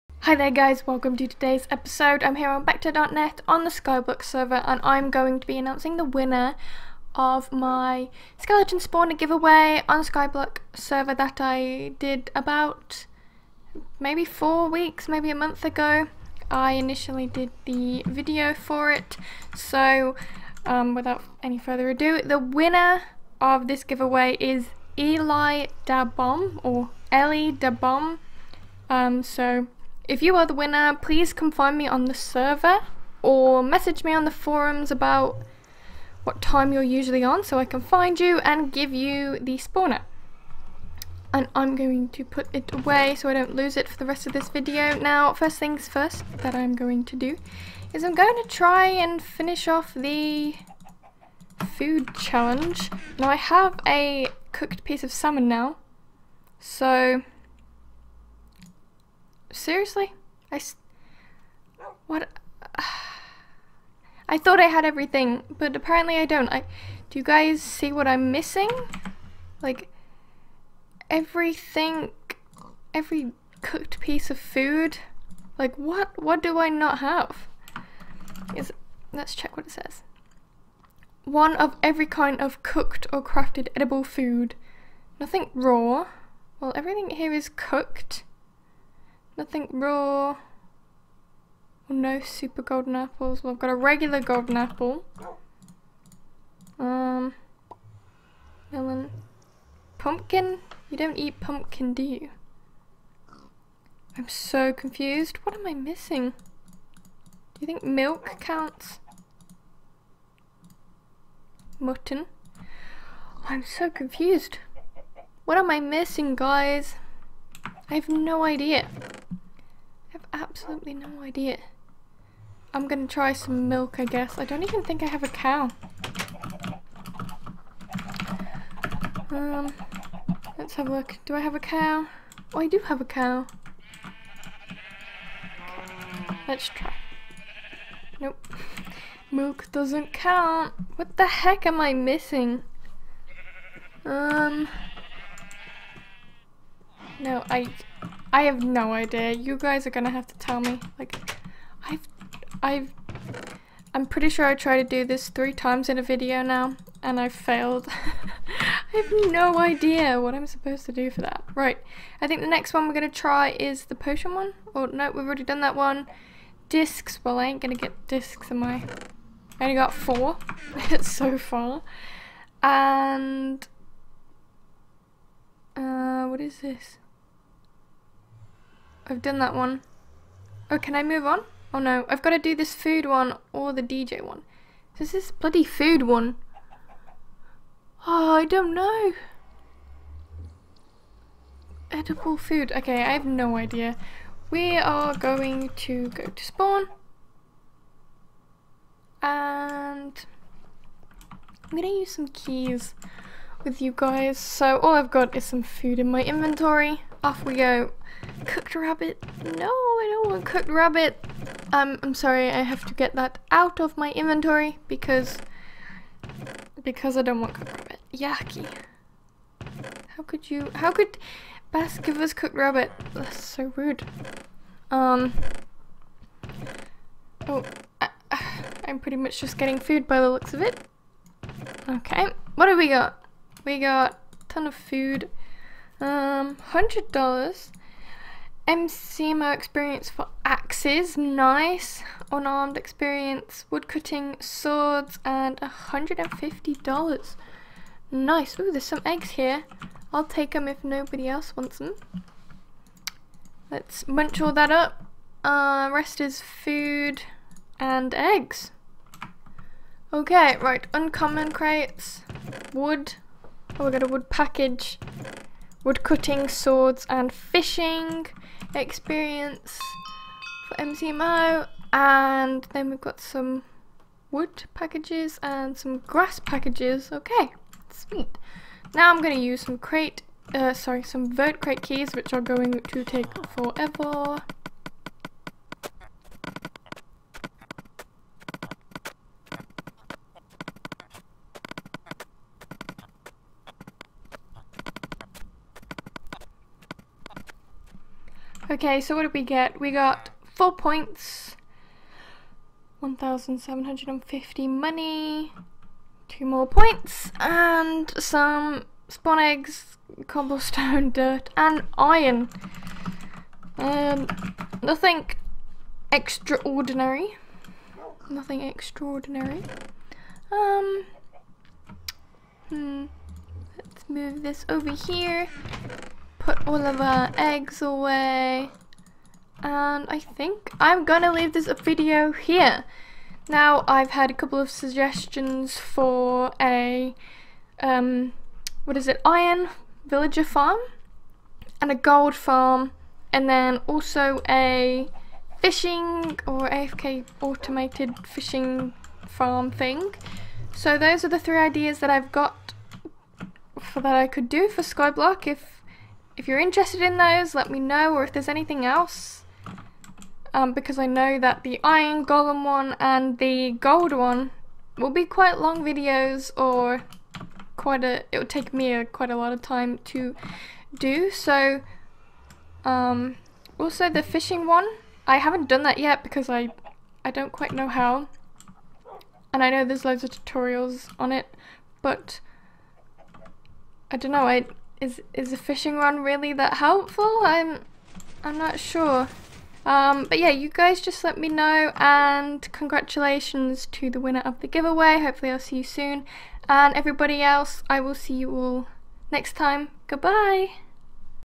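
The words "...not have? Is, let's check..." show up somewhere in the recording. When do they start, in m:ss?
1:16.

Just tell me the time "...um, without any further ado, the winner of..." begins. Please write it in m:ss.
0:20.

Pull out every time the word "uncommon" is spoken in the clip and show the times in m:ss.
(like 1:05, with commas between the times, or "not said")
4:20.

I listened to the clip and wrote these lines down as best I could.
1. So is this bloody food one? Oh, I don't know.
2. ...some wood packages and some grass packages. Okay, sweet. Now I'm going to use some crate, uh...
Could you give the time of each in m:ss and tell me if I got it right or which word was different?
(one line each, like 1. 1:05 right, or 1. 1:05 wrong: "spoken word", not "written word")
1. 3:04 right
2. 4:33 right.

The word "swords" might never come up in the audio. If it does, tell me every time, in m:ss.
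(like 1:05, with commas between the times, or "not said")
4:04, 4:26.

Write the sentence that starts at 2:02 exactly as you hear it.
I'm gonna try some milk, I guess.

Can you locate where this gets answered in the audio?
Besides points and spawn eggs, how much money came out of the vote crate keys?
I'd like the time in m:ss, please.
5:03.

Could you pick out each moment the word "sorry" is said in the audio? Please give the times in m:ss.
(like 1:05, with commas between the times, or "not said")
3:32, 4:40.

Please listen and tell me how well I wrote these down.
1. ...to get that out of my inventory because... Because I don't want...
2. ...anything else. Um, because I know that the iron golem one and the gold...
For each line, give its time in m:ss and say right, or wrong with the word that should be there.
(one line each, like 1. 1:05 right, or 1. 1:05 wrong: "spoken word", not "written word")
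1. 3:32 right
2. 5:58 right.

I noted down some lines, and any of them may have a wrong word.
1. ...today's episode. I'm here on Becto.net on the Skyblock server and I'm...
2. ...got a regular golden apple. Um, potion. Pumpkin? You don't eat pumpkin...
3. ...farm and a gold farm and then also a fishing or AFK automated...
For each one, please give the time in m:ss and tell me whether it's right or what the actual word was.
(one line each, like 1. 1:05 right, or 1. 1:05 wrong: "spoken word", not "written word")
1. 0:01 right
2. 1:33 wrong: "melon", not "potion"
3. 5:40 right.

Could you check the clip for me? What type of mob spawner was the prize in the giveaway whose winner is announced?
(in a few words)
Skeleton.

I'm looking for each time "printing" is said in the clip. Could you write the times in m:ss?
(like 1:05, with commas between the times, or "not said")
not said.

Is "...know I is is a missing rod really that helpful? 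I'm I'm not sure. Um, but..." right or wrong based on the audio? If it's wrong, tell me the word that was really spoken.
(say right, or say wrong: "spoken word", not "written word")
wrong: "fishing", not "missing".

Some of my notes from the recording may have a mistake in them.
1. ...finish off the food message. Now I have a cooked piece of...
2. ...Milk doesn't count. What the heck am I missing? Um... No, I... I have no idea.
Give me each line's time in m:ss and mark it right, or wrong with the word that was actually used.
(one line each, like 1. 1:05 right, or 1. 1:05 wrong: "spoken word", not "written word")
1. 0:49 wrong: "challenge", not "message"
2. 2:19 right.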